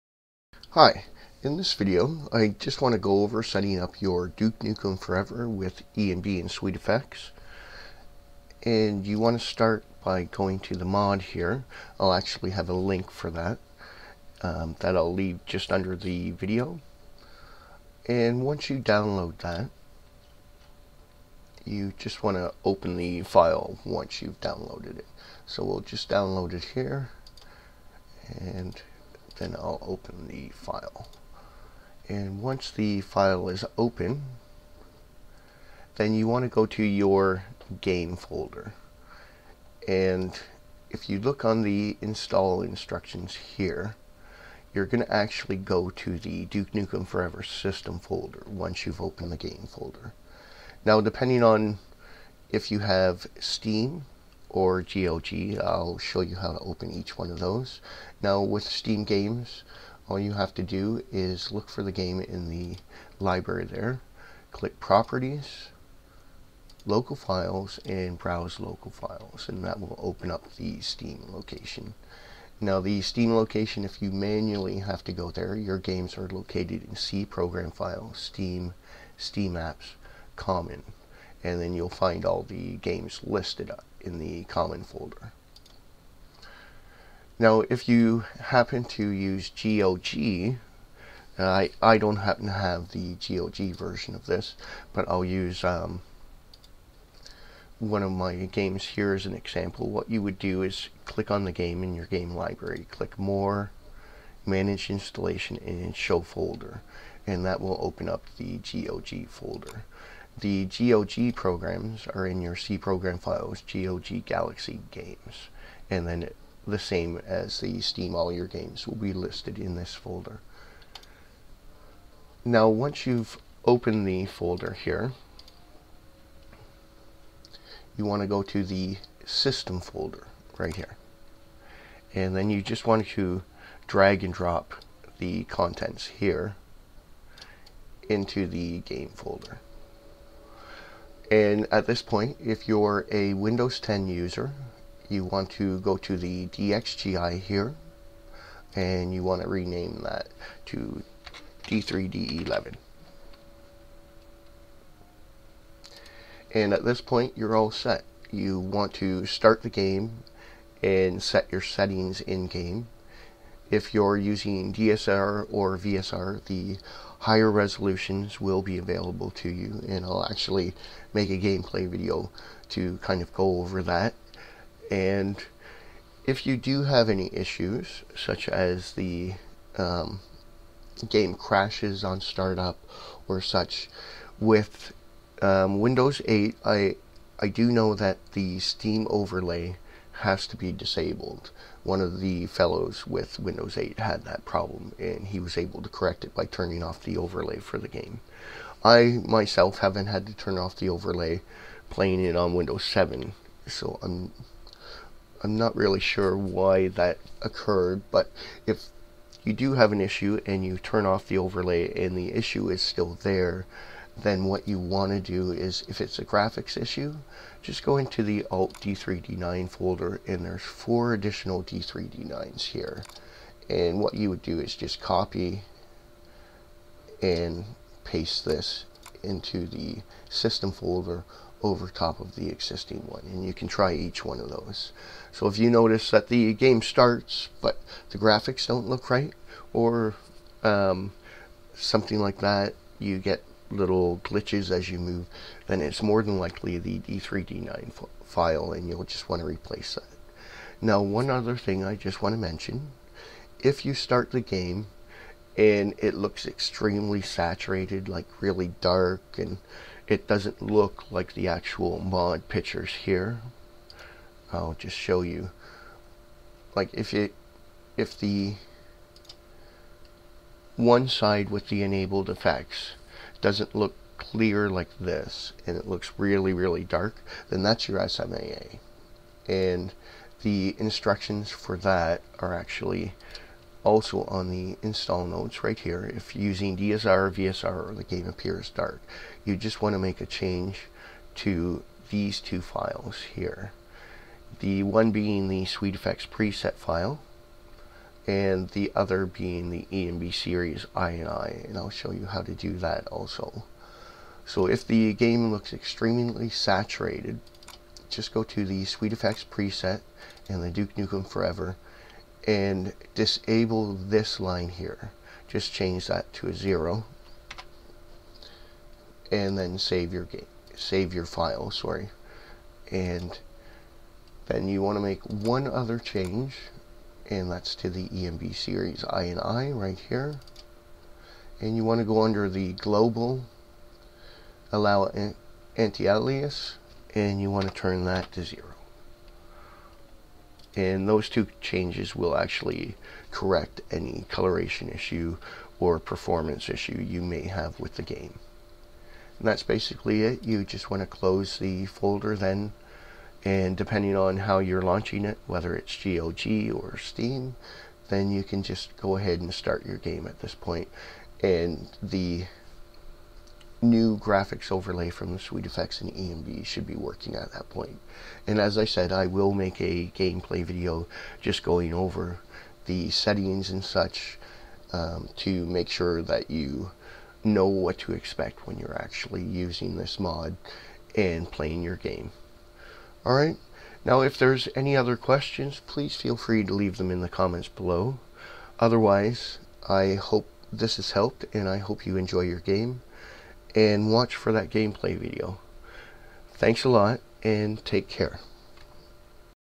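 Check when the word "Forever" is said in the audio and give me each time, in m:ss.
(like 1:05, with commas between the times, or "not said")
0:04, 0:47, 5:11.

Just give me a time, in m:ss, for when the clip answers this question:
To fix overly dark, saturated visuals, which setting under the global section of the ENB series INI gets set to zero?
5:34.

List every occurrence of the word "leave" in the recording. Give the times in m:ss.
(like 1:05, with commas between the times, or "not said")
0:15, 6:26.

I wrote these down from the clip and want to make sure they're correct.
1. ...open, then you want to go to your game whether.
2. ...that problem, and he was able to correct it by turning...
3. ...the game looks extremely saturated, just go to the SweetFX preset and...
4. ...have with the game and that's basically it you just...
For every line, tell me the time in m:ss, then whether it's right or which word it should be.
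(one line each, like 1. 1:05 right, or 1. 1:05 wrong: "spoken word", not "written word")
1. 0:33 wrong: "folder", not "whether"
2. 3:14 right
3. 5:04 right
4. 5:47 right.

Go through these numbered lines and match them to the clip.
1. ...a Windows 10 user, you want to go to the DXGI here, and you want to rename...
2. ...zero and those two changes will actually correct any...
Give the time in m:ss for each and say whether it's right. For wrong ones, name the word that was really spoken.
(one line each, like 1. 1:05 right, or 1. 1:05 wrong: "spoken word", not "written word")
1. 2:23 right
2. 5:38 right.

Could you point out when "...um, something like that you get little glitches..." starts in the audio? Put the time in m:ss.
4:00.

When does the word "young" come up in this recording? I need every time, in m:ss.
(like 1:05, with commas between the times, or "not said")
not said.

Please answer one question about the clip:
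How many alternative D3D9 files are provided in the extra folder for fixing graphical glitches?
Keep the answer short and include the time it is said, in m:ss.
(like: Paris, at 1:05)
4, at 3:40.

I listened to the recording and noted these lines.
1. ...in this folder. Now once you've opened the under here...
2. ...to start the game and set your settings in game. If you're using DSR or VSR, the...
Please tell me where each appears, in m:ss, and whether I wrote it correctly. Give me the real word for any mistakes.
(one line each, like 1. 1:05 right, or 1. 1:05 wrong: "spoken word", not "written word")
1. 1:59 wrong: "folder", not "under"
2. 2:38 right.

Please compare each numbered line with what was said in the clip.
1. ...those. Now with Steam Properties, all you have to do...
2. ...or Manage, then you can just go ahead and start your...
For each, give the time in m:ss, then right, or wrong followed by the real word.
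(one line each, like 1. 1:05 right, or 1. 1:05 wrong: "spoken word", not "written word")
1. 0:57 wrong: "Games", not "Properties"
2. 5:56 wrong: "Steam", not "Manage".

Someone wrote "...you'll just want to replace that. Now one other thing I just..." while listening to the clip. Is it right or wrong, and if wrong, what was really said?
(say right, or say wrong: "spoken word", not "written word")
right.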